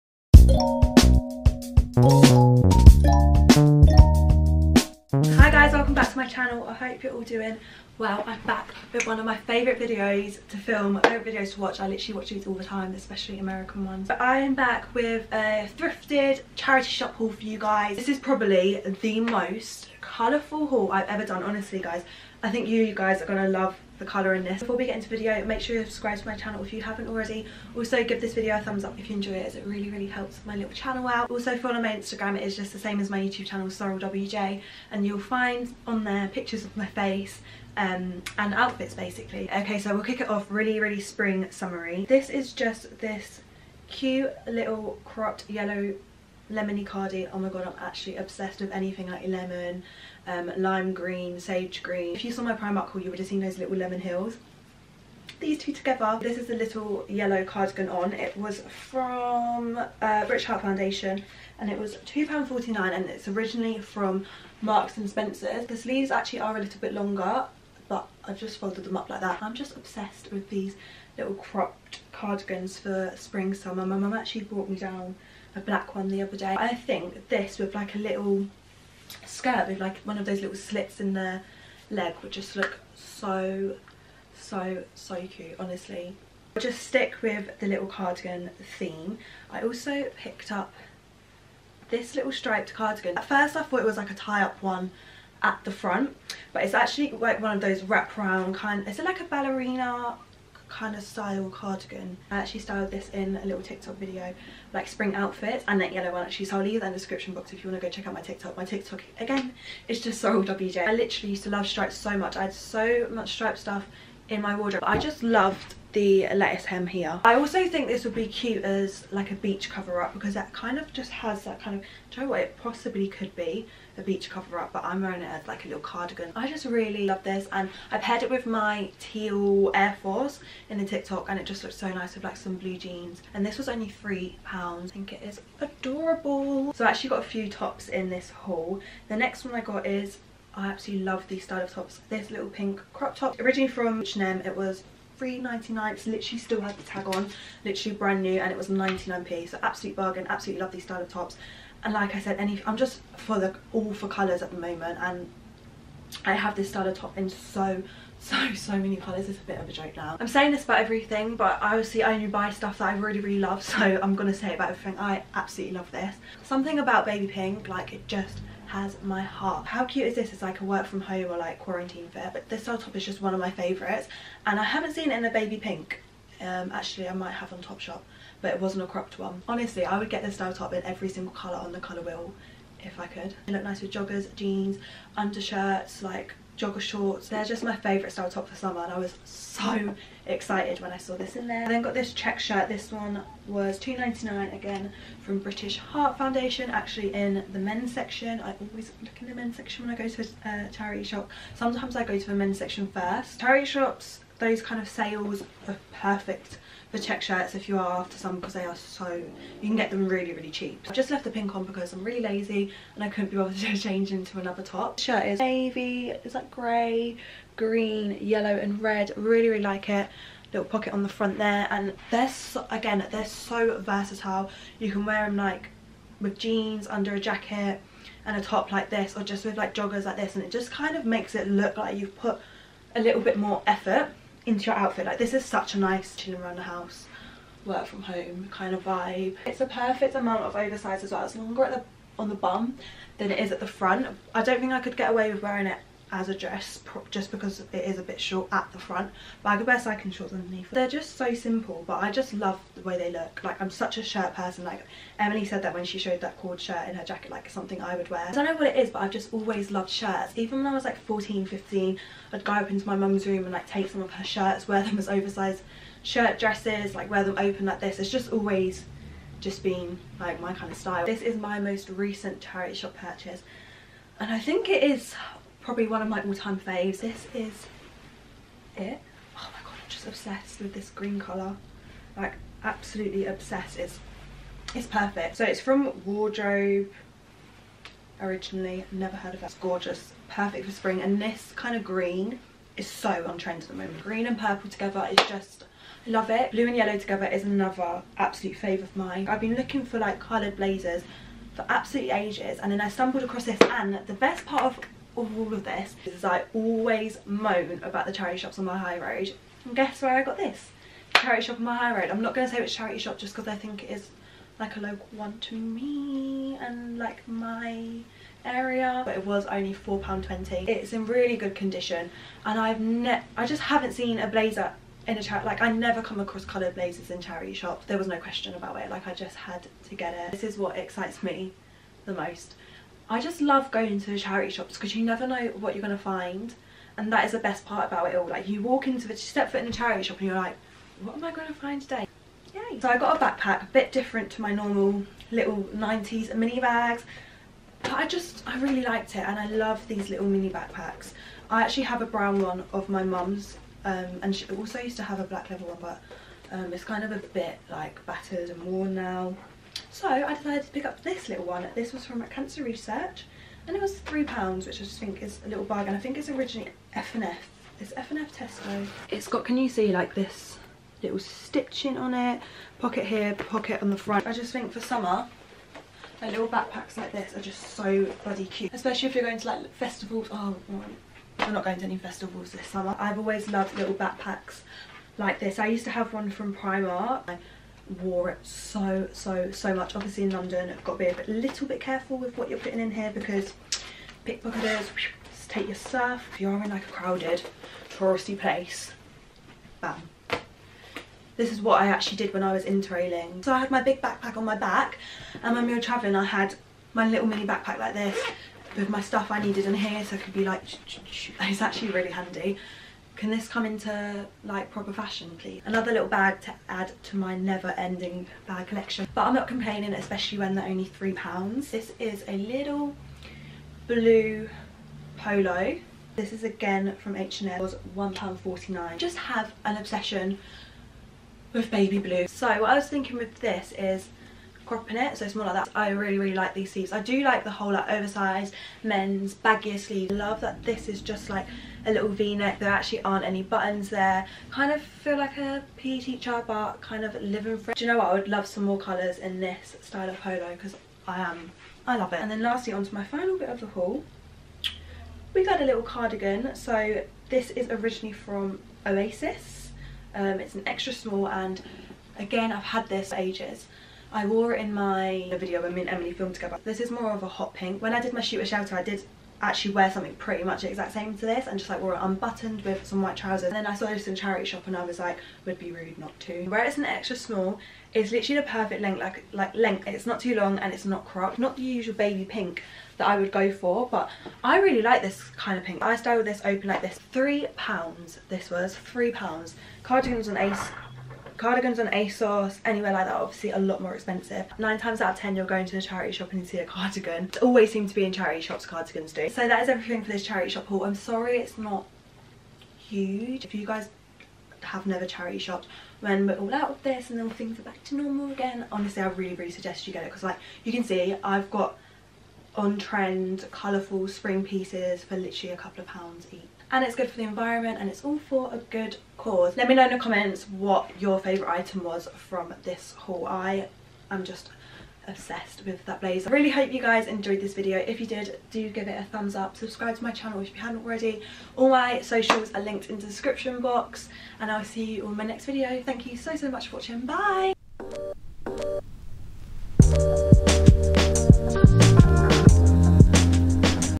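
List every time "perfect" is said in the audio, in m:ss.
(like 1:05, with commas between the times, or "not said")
3:25, 3:59, 4:44, 4:50, 7:58.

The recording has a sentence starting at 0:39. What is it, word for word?
Okay, so we'll kick it off really, really spring summery.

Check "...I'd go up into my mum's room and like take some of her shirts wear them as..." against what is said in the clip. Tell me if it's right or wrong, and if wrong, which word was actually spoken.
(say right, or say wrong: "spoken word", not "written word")
right.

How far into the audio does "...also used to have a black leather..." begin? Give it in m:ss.
5:54.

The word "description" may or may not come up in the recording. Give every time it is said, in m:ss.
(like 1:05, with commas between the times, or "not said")
1:46, 8:53.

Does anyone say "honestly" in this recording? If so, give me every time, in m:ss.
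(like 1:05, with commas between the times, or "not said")
0:21, 1:25, 2:59, 8:28.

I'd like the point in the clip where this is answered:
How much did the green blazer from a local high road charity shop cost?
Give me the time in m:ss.
5:19.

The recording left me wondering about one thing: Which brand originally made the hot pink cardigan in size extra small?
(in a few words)
Oasis.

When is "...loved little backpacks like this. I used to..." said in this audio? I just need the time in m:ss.
6:23.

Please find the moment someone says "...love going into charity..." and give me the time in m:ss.
5:33.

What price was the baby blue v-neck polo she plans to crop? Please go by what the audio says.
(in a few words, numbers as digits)
£1.49.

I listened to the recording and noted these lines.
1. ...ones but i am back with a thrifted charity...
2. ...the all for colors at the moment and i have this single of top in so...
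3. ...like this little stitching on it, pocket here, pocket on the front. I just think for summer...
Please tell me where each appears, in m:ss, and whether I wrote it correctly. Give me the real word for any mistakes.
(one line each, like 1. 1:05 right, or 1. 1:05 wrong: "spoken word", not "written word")
1. 0:13 right
2. 2:33 wrong: "style", not "single"
3. 6:09 right.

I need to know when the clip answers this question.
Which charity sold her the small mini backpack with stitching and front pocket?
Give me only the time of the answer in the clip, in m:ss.
6:02.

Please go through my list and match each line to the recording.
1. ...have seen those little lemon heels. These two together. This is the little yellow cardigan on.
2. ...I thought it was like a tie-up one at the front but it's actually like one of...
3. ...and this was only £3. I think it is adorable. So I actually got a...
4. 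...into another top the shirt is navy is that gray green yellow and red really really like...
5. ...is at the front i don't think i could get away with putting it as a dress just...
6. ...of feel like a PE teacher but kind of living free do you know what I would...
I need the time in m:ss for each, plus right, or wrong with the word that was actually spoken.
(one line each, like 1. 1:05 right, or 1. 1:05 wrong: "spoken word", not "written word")
1. 0:53 right
2. 1:33 right
3. 2:13 right
4. 3:34 right
5. 4:03 wrong: "wearing", not "putting"
6. 7:24 right.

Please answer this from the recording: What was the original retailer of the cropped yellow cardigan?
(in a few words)
Marks and Spencer's.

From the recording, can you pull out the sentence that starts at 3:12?
This one was $2.99 again from British Heart Foundation, actually in the men's section.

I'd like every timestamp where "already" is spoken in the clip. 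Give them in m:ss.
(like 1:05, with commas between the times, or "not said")
0:27, 8:50.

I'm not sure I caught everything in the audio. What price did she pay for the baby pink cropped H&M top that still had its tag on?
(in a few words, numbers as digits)
99p.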